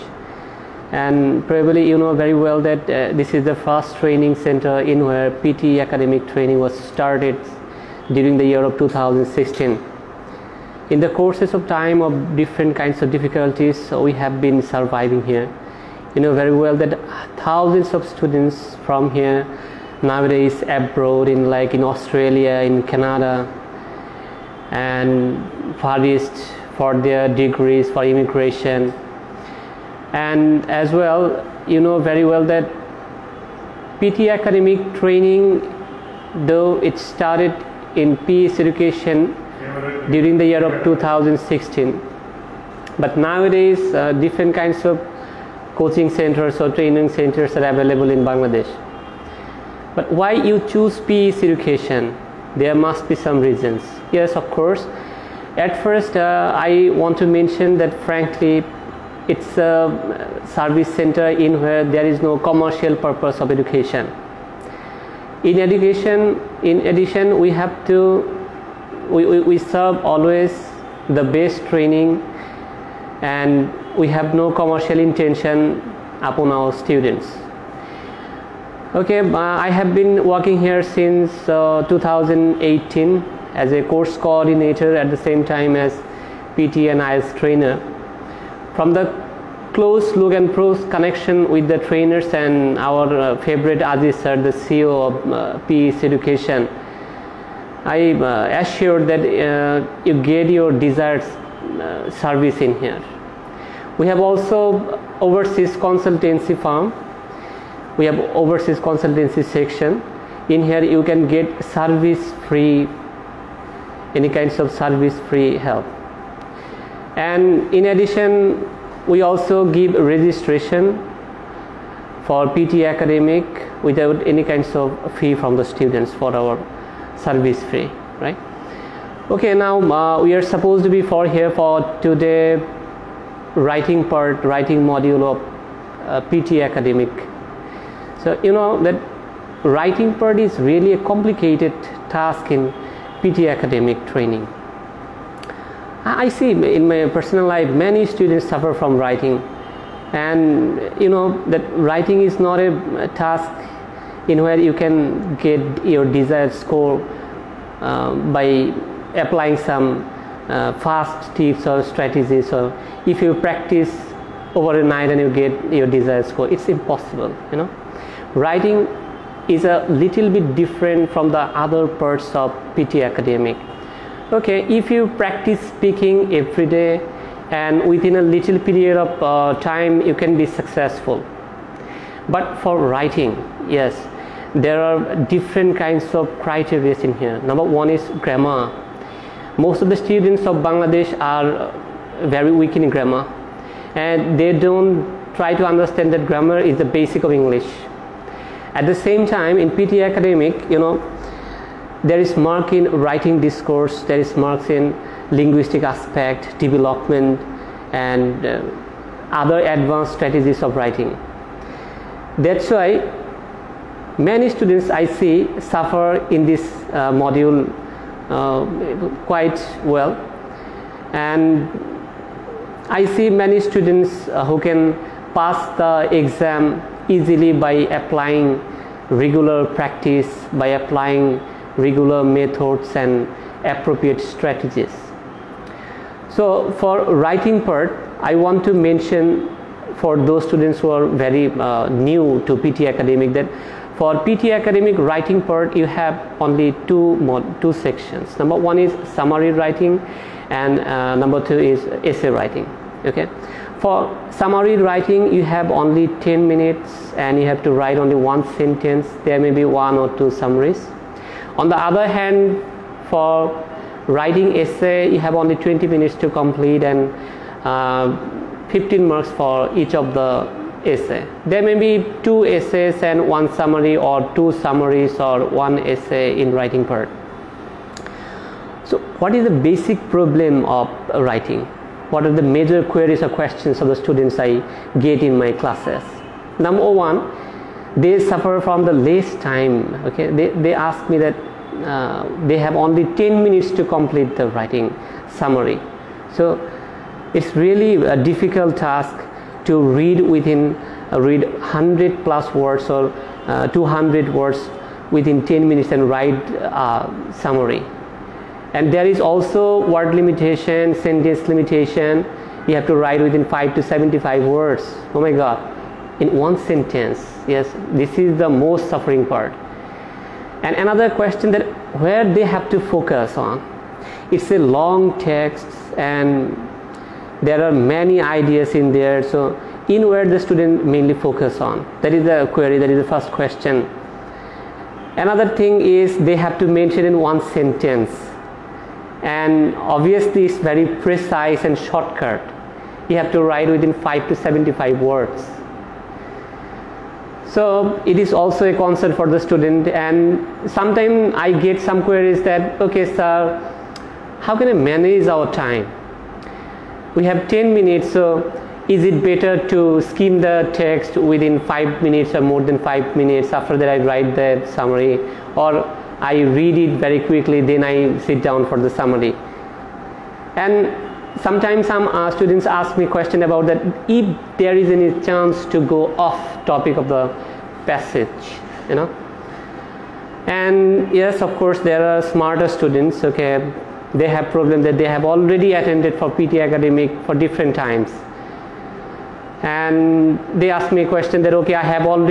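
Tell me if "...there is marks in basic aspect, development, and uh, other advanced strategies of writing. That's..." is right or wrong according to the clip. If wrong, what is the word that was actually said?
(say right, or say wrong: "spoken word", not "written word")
wrong: "linguistic", not "basic".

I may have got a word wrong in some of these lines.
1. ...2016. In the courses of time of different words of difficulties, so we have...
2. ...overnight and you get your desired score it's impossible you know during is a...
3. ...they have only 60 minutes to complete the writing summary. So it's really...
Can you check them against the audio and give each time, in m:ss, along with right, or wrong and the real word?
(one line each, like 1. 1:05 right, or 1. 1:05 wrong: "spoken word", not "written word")
1. 0:08 wrong: "kinds", not "words"
2. 2:44 wrong: "writing", not "during"
3. 4:52 wrong: "10", not "60".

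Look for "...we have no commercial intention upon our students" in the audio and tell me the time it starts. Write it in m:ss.
1:13.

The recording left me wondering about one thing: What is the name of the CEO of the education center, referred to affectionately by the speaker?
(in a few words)
Aziz.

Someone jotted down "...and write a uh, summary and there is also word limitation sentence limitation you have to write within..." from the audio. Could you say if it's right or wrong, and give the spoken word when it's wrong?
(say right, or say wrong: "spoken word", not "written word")
right.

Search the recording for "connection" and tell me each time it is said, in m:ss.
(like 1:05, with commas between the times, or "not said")
1:30.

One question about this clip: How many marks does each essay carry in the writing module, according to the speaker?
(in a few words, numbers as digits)
15.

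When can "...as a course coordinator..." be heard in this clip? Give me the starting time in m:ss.
1:23.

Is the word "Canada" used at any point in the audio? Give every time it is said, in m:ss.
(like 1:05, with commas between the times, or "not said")
0:22.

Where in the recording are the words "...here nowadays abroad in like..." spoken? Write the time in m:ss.
0:19.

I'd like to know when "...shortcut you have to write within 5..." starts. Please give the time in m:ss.
5:41.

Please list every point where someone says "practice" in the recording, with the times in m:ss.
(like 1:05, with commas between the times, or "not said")
2:43, 2:55, 3:49.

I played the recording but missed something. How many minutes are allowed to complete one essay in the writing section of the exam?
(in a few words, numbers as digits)
20 minutes.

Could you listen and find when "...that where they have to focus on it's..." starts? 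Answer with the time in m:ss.
5:21.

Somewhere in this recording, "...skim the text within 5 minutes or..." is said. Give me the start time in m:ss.
6:00.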